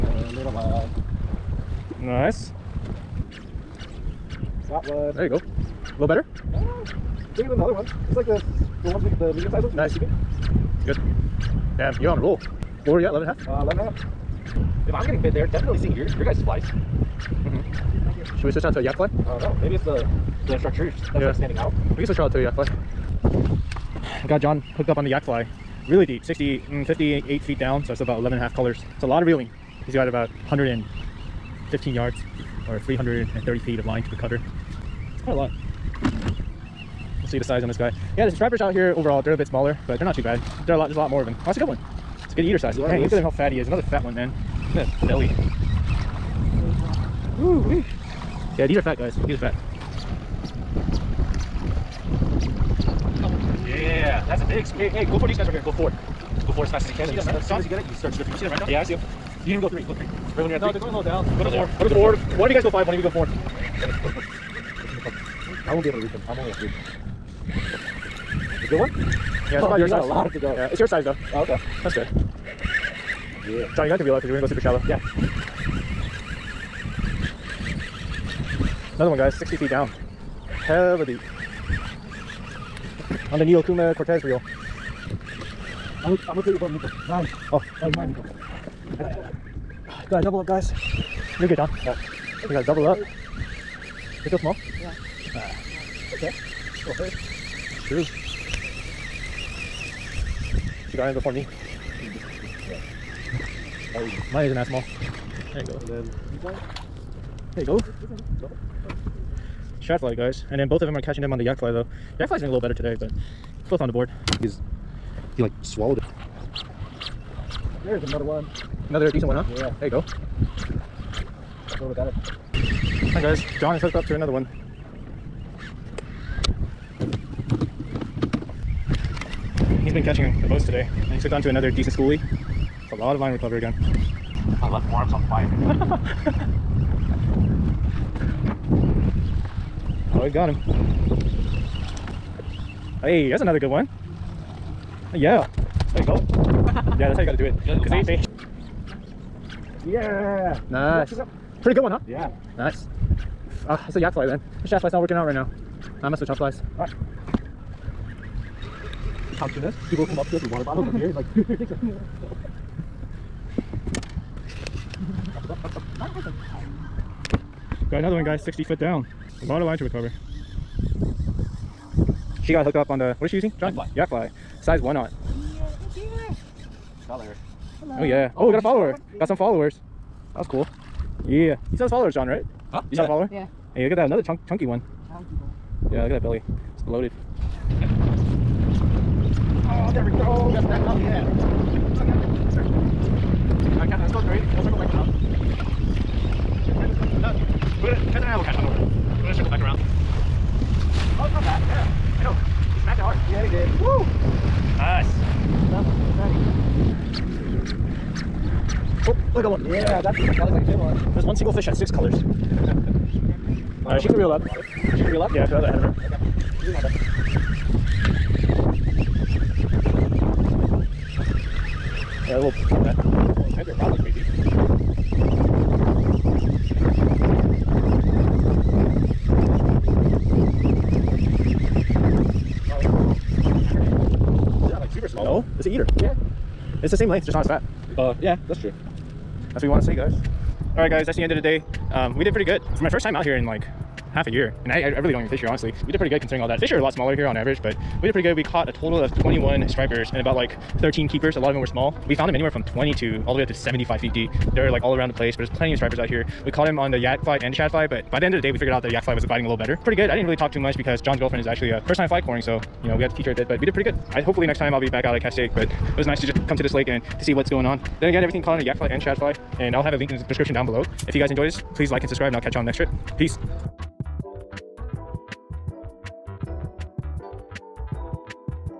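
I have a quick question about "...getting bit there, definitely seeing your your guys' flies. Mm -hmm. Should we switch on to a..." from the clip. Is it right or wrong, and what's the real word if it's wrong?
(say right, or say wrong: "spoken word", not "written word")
right.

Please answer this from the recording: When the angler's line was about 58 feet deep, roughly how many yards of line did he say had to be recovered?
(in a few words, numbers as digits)
115 yards.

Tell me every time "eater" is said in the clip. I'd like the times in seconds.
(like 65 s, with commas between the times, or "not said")
42 s, 235 s.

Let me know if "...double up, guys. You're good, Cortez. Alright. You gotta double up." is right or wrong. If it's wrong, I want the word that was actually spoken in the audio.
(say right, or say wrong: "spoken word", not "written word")
wrong: "John", not "Cortez".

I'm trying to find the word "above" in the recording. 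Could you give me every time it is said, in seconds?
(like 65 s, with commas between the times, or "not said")
86 s.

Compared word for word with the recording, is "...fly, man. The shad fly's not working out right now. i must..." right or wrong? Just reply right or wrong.
right.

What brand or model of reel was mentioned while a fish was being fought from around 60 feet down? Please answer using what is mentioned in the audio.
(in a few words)
Neo Cortez.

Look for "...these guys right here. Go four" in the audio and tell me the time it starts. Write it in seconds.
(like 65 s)
55 s.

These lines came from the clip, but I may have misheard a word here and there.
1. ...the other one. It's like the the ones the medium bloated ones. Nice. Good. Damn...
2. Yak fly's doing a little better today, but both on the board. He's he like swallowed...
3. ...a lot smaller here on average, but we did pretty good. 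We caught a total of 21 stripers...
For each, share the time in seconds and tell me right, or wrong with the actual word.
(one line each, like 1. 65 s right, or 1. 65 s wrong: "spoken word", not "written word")
1. 7 s wrong: "sized", not "bloated"
2. 112 s right
3. 246 s right.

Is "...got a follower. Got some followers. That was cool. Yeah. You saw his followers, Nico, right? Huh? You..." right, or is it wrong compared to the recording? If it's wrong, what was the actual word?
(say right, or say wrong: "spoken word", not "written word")
wrong: "Sean", not "Nico".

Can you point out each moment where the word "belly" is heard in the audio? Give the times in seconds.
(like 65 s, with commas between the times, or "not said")
45 s, 186 s.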